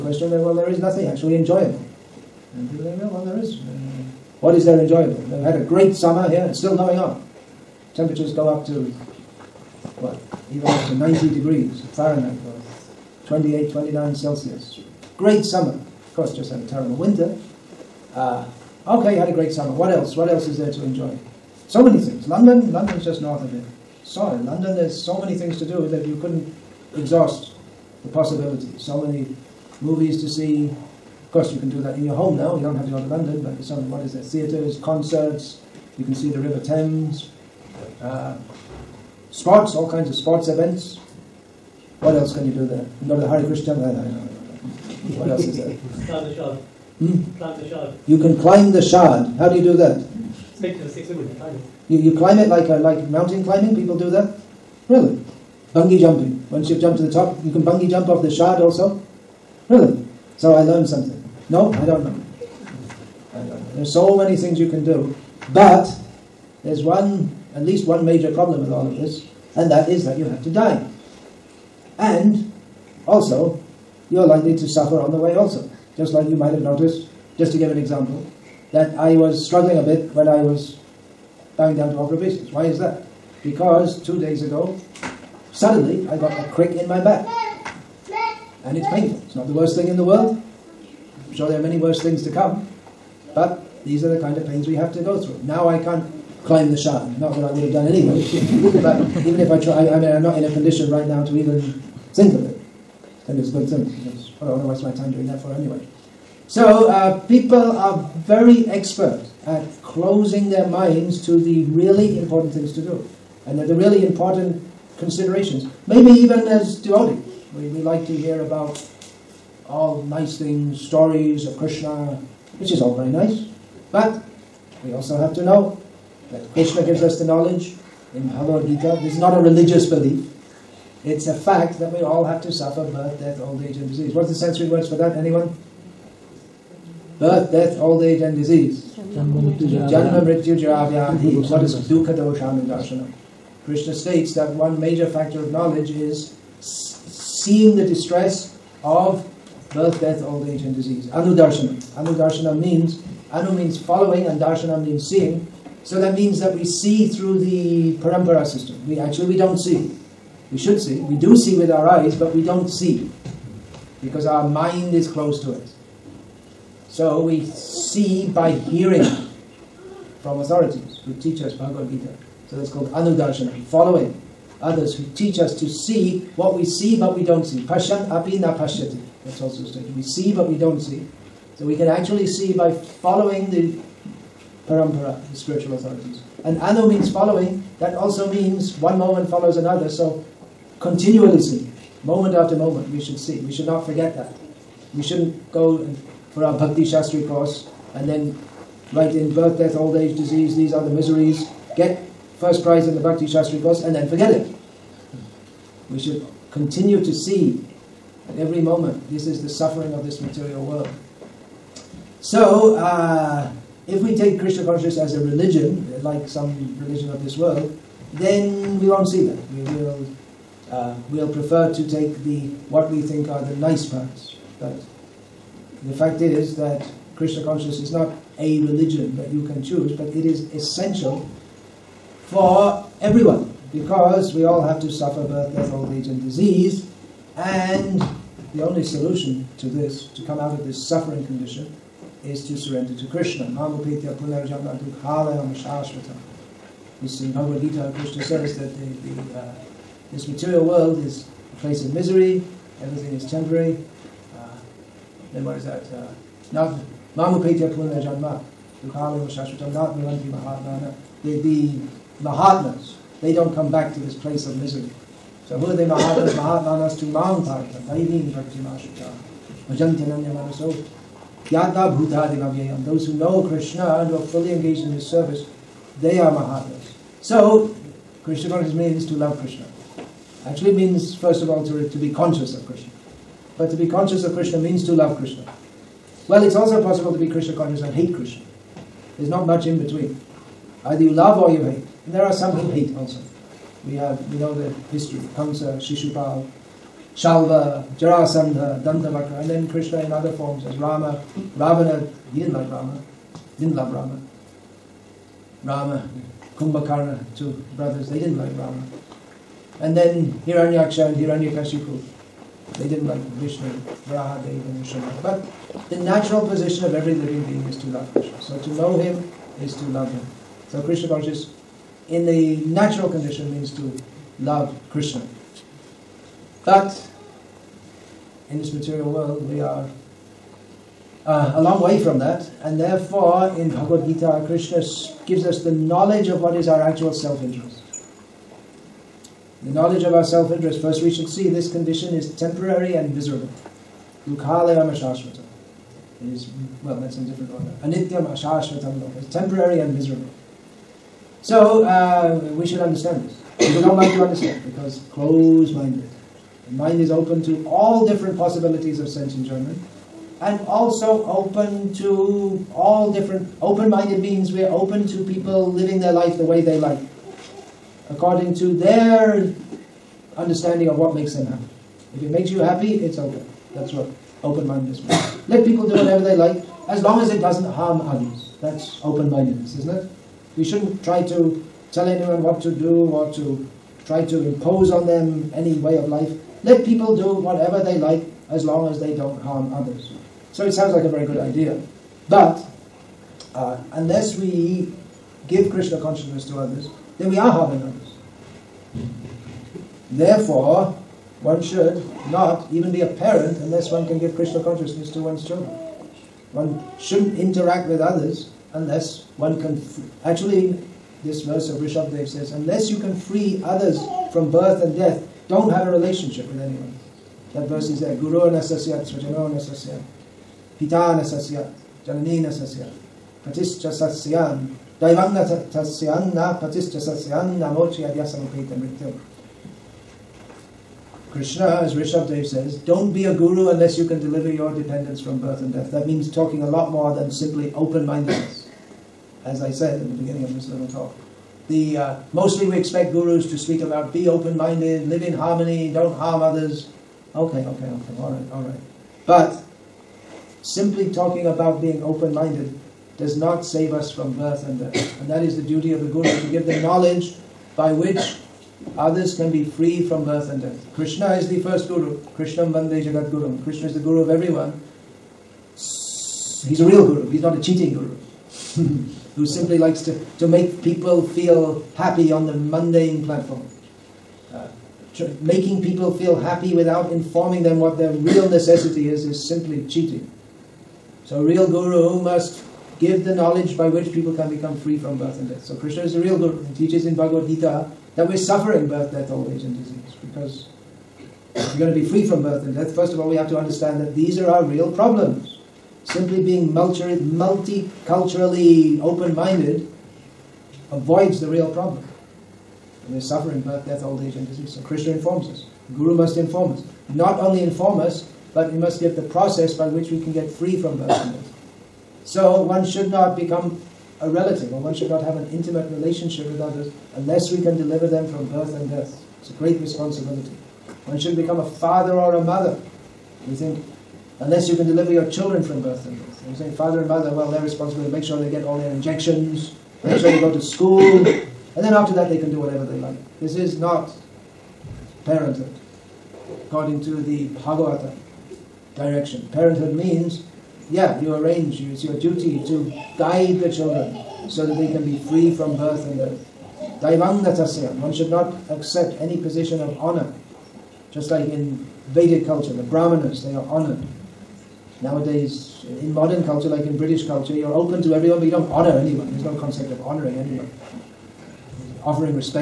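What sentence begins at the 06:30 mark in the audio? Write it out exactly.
So it sounds like a very good idea.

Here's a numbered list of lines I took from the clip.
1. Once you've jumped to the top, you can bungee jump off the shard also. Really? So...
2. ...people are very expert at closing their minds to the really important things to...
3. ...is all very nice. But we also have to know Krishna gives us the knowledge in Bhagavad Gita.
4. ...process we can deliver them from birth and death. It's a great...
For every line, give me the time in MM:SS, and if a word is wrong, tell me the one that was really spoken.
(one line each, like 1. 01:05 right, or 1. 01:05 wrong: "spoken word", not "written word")
1. 00:56 right
2. 01:47 right
3. 02:02 right
4. 08:37 wrong: "unless", not "process".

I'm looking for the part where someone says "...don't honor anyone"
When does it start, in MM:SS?
09:18.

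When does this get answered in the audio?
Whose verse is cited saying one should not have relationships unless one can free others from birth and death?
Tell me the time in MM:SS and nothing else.
06:51.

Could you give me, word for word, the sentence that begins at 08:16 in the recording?
Simply being multiculturally open-minded avoids the real problem.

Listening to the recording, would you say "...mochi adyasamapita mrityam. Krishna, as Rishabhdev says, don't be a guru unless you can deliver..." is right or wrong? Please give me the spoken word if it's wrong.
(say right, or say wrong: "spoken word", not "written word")
right.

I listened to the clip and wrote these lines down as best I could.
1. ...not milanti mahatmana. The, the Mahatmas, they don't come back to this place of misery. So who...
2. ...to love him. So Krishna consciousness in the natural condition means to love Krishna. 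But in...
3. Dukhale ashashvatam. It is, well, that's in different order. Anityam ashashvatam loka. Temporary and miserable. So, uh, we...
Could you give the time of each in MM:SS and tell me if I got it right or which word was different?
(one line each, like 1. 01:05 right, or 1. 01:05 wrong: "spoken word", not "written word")
1. 04:19 right
2. 05:19 right
3. 05:44 right.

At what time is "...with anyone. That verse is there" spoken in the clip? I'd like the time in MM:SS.
06:56.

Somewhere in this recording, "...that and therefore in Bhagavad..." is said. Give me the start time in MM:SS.
05:32.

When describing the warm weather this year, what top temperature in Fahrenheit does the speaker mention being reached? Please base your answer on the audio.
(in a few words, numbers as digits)
90 degrees.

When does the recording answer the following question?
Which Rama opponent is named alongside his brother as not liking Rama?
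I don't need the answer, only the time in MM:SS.
05:06.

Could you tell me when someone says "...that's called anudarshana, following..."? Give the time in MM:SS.
02:52.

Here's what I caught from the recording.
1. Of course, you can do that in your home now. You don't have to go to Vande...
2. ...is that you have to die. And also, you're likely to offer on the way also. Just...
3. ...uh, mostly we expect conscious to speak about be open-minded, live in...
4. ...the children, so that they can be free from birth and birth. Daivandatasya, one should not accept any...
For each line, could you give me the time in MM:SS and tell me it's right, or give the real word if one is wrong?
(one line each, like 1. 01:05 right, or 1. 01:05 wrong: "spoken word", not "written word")
1. 00:30 wrong: "London", not "Vande"
2. 01:09 wrong: "suffer", not "offer"
3. 07:21 wrong: "gurus", not "conscious"
4. 09:03 wrong: "death", not "birth".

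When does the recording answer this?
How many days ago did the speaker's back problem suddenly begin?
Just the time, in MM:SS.
01:24.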